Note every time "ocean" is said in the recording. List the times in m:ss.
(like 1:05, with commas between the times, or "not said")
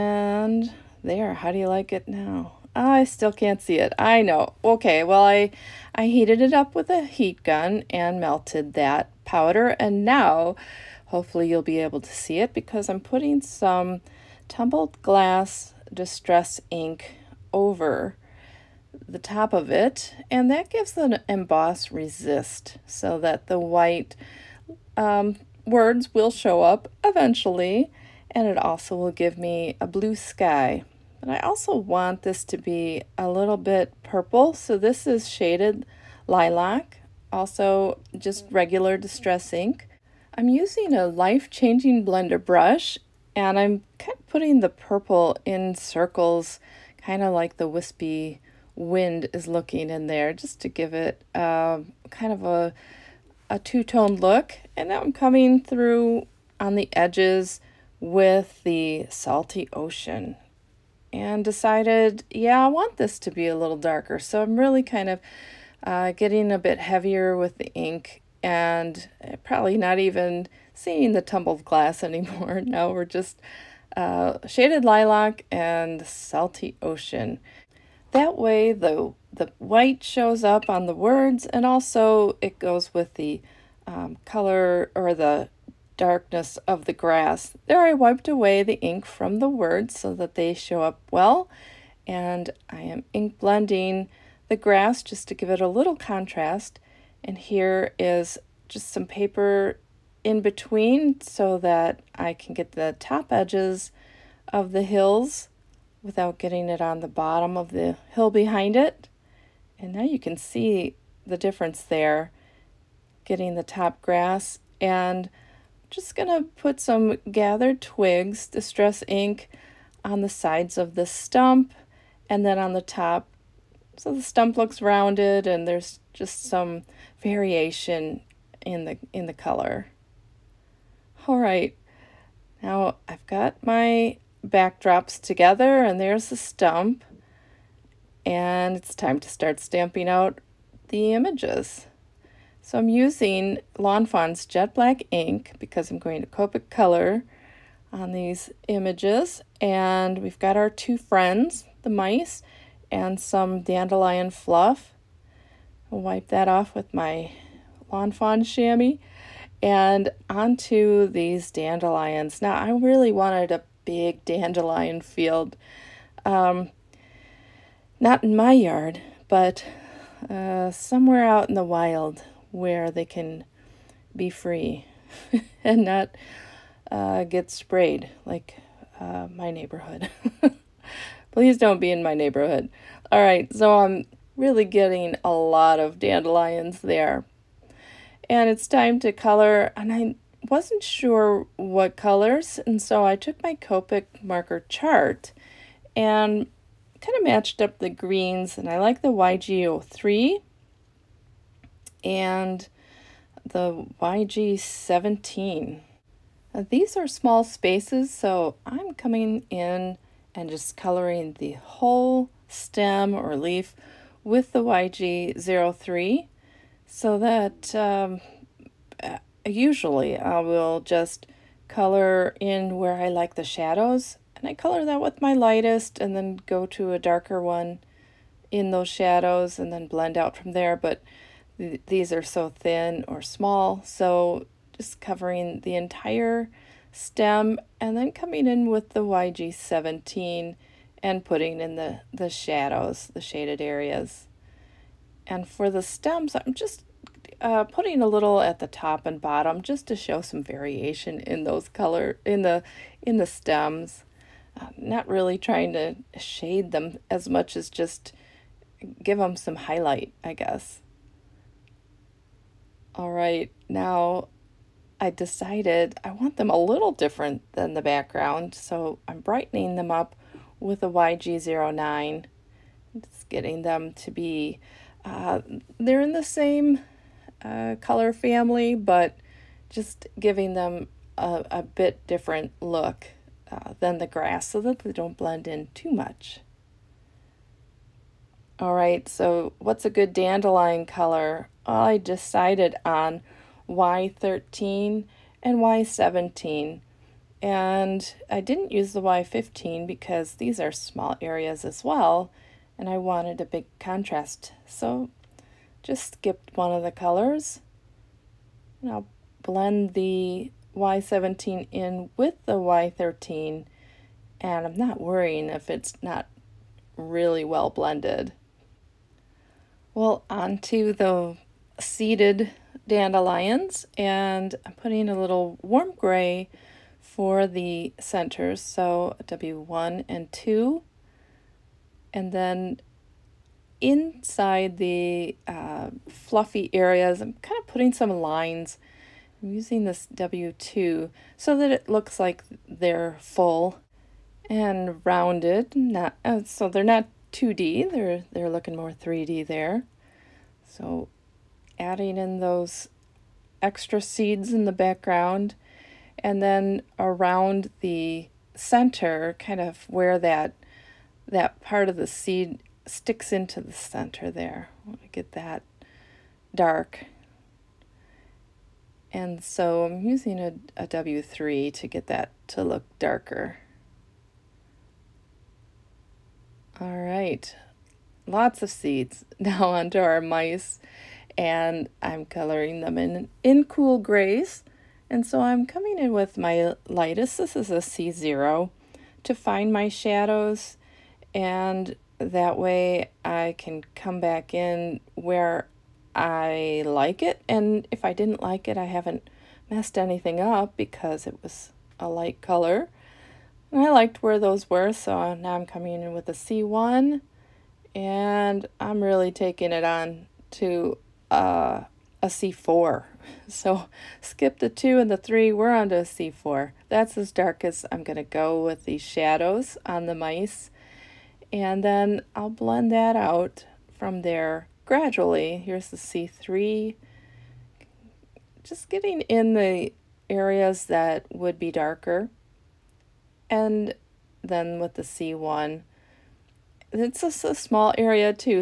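0:59, 1:16.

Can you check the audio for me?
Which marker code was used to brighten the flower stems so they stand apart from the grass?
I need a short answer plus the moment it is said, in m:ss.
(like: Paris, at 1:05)
YG09, at 4:30.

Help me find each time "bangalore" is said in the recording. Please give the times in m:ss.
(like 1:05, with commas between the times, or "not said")
not said.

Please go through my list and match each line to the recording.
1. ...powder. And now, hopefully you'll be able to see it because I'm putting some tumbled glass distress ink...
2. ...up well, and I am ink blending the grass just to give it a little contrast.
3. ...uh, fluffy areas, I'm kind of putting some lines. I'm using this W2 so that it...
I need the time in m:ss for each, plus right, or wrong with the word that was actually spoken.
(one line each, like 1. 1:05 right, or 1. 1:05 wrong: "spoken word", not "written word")
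1. 0:09 right
2. 1:30 right
3. 5:35 right.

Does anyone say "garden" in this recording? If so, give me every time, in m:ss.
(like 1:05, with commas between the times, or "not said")
not said.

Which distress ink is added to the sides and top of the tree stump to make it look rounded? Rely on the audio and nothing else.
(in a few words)
Gathered twigs.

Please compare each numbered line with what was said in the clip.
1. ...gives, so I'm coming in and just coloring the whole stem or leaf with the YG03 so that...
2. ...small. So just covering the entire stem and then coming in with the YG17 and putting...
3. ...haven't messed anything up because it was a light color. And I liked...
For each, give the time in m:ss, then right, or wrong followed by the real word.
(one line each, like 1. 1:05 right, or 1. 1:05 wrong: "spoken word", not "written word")
1. 3:27 wrong: "spaces", not "gives"
2. 3:53 right
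3. 6:38 right.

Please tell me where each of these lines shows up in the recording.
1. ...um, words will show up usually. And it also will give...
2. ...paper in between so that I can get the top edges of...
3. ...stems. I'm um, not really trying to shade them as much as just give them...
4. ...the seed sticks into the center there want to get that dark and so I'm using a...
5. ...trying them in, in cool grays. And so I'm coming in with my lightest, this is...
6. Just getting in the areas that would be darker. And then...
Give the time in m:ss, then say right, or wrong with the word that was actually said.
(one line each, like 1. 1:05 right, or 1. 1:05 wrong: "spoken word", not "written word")
1. 0:24 wrong: "eventually", not "usually"
2. 1:39 right
3. 4:13 right
4. 6:01 right
5. 6:22 wrong: "coloring", not "trying"
6. 7:08 right.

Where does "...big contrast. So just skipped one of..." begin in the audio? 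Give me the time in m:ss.
5:03.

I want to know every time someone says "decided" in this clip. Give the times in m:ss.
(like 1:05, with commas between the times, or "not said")
1:01, 4:25, 4:51.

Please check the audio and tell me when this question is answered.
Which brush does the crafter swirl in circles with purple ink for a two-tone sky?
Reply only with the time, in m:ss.
0:41.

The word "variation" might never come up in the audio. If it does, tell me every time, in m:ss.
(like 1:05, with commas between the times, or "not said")
2:07, 4:10.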